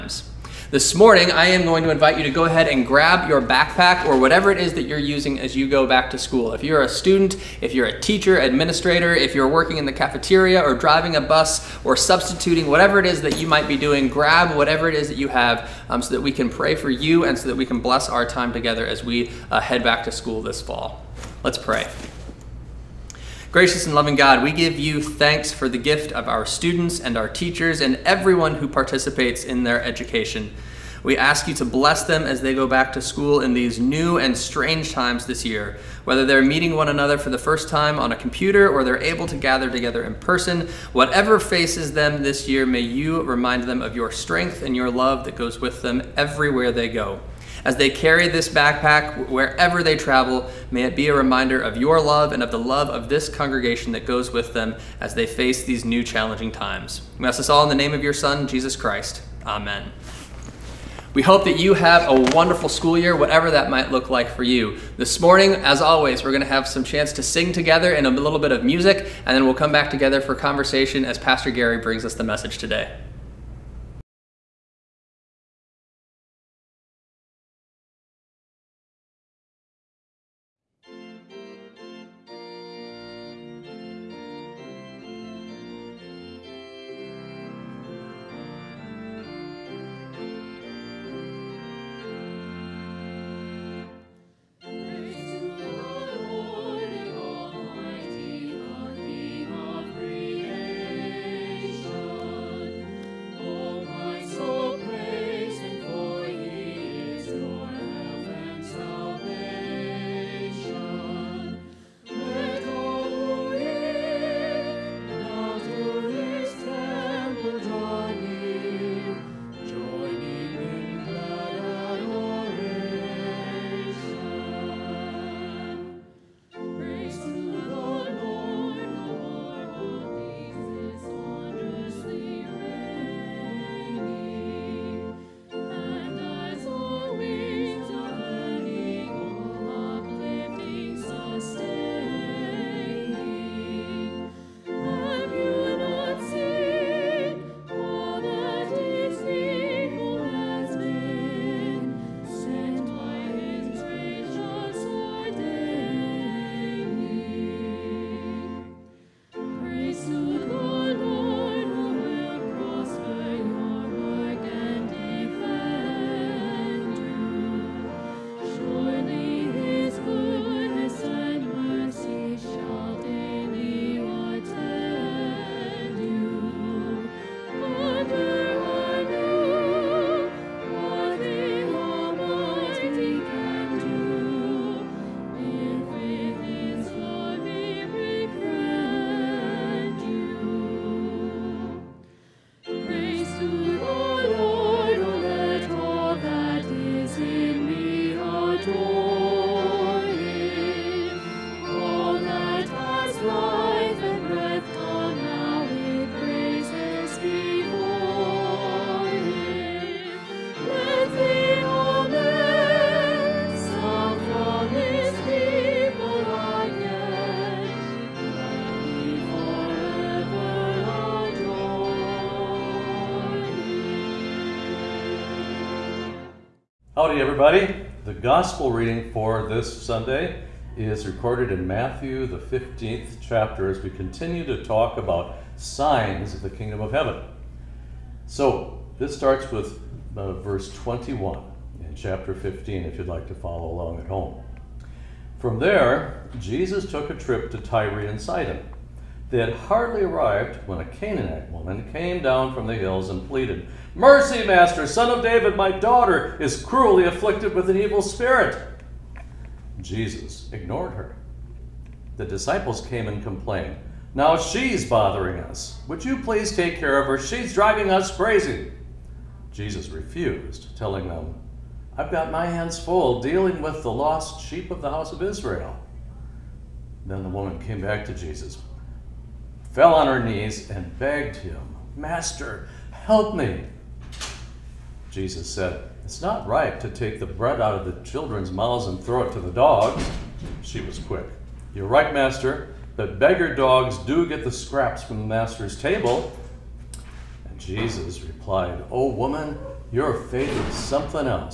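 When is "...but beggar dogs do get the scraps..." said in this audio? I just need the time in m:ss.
4:52.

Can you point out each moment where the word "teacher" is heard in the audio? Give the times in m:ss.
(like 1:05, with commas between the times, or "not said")
0:08, 0:27.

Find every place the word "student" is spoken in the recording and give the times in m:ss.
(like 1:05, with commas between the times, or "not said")
0:06, 0:26.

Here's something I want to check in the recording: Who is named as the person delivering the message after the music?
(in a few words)
Pastor Gary.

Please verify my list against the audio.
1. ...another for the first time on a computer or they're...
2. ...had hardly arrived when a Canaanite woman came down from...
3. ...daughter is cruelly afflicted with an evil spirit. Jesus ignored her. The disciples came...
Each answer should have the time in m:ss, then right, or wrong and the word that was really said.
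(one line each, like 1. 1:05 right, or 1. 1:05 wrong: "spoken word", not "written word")
1. 0:36 right
2. 4:09 right
3. 4:15 right.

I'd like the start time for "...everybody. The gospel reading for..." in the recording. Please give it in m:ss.
3:47.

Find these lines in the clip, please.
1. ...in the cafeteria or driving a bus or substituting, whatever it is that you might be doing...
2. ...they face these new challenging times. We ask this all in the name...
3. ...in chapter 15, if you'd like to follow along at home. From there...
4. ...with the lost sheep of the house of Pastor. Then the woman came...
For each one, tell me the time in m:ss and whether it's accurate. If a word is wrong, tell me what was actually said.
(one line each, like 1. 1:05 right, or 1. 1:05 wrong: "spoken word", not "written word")
1. 0:09 right
2. 0:55 right
3. 4:01 right
4. 4:33 wrong: "Israel", not "Pastor".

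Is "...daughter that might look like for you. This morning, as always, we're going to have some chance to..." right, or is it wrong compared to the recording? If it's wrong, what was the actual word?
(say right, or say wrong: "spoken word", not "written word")
wrong: "whatever", not "daughter".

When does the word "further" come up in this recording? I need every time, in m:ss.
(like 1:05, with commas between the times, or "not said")
not said.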